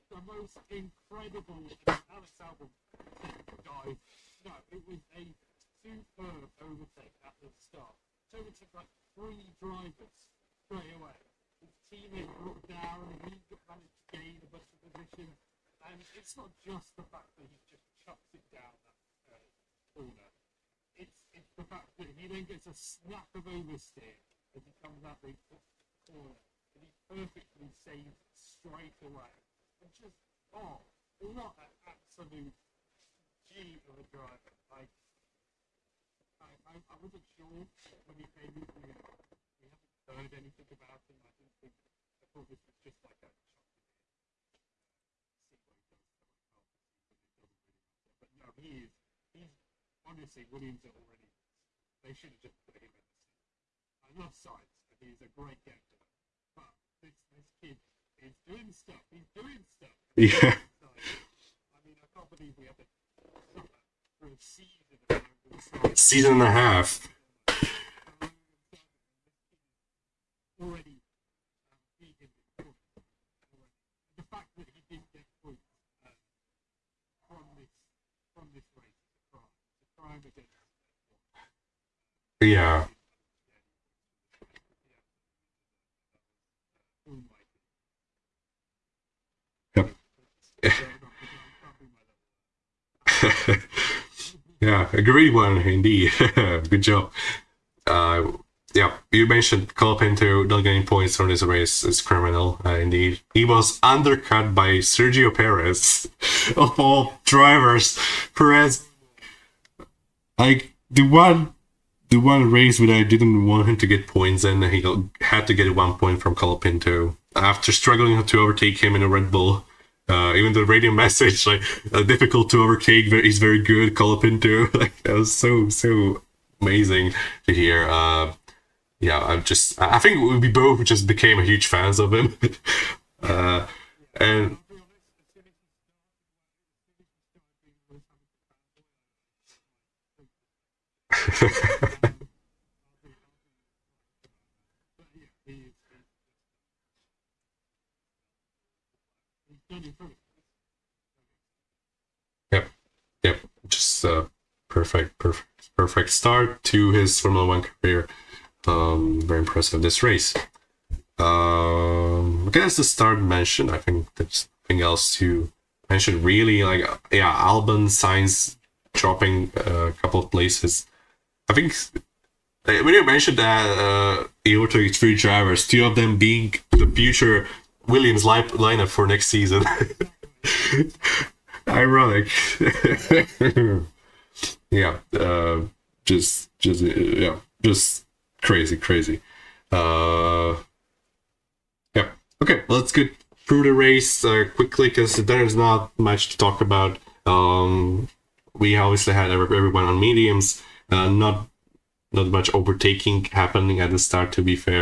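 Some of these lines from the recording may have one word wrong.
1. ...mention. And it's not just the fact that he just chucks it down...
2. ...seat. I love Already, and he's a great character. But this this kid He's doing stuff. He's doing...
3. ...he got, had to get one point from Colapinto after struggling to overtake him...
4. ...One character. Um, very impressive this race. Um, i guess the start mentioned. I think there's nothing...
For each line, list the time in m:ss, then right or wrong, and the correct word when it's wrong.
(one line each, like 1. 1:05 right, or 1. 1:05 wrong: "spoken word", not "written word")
1. 0:14 wrong: "position", not "mention"
2. 0:53 wrong: "Sainz", not "Already"
3. 1:54 right
4. 2:37 wrong: "career", not "character".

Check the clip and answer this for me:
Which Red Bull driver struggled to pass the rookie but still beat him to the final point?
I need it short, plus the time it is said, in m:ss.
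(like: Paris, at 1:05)
Sergio Perez, at 1:44.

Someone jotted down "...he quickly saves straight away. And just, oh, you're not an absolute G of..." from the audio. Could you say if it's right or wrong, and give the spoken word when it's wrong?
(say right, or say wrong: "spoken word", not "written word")
wrong: "perfectly", not "quickly".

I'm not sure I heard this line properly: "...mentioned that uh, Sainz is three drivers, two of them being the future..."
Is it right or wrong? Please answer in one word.
wrong.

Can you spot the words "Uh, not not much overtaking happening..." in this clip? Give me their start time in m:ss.
3:20.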